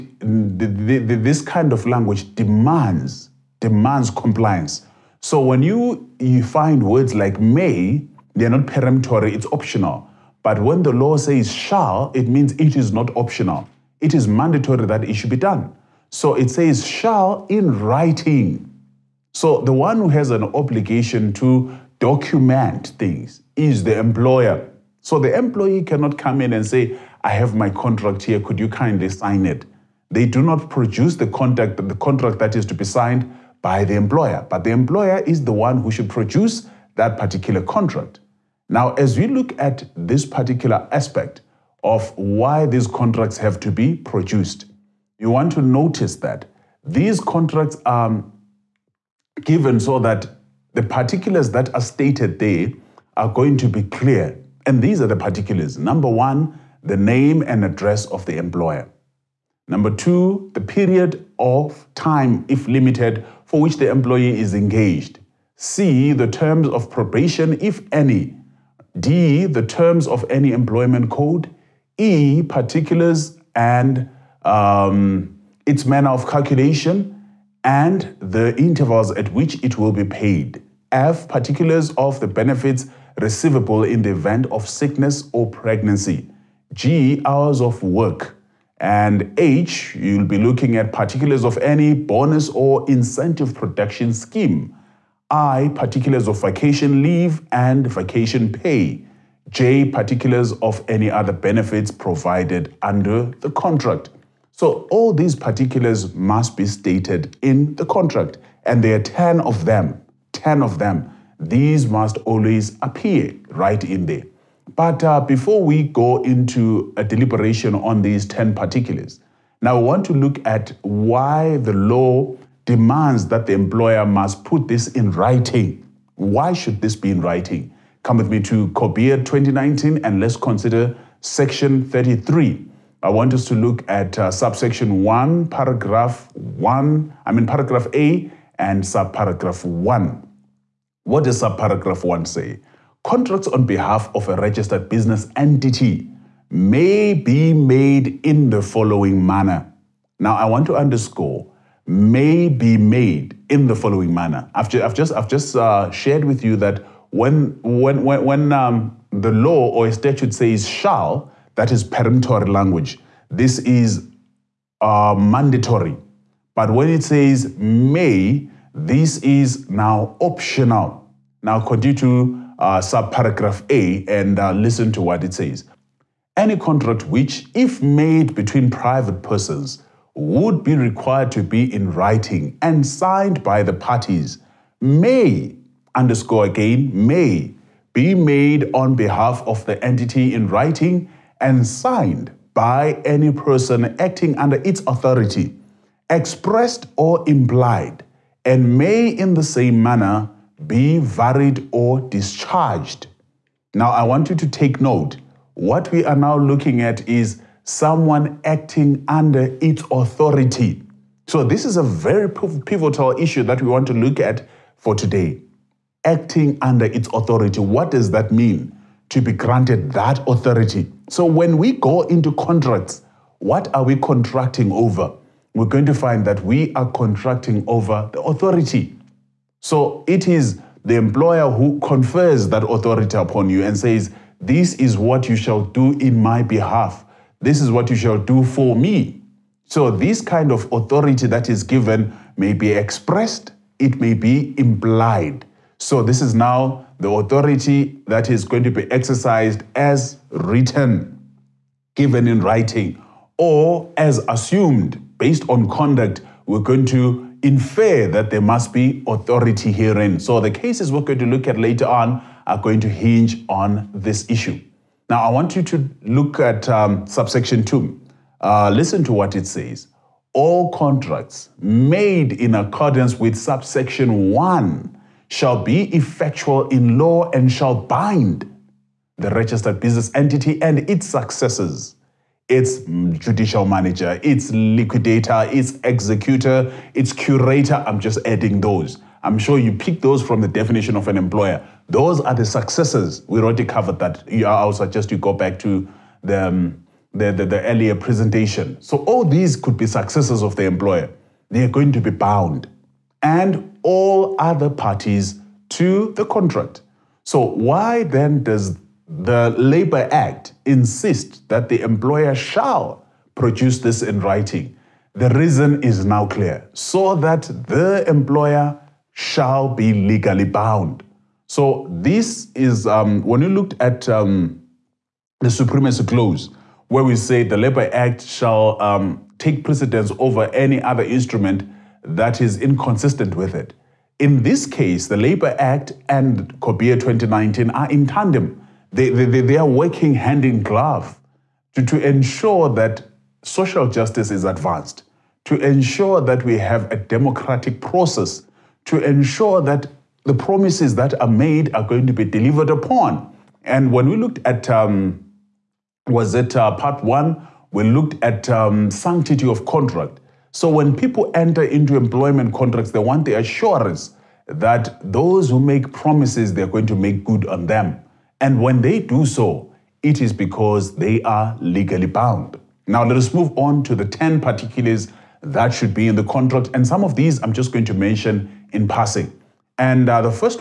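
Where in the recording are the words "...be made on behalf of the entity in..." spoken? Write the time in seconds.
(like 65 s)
187 s.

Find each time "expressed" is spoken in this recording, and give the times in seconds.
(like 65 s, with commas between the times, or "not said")
196 s, 242 s.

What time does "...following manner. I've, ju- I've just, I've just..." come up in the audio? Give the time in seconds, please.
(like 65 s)
153 s.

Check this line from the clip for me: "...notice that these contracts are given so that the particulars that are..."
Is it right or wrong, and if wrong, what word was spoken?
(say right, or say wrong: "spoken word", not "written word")
right.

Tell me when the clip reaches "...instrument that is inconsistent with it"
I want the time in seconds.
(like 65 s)
331 s.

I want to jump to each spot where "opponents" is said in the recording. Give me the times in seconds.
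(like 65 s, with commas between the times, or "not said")
not said.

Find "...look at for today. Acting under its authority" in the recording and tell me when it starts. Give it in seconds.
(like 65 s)
213 s.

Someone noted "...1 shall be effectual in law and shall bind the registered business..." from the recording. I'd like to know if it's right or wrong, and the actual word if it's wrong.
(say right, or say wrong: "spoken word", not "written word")
right.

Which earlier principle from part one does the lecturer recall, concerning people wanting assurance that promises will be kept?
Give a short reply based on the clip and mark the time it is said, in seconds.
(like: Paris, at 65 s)
sanctity of contract, at 358 s.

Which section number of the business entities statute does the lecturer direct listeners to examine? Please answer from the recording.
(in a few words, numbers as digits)
33.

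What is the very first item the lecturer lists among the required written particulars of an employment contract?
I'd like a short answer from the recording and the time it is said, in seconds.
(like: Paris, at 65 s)
name and address of the employer, at 56 s.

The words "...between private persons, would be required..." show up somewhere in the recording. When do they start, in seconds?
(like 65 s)
178 s.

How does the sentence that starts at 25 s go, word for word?
So the employee cannot come in and say, I have my contract here, could you kindly sign it?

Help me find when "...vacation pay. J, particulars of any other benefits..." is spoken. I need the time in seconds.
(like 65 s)
97 s.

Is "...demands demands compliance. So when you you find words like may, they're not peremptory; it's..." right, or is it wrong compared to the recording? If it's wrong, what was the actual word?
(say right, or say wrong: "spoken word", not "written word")
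right.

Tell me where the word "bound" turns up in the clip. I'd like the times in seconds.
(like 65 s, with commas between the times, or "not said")
302 s, 320 s, 372 s.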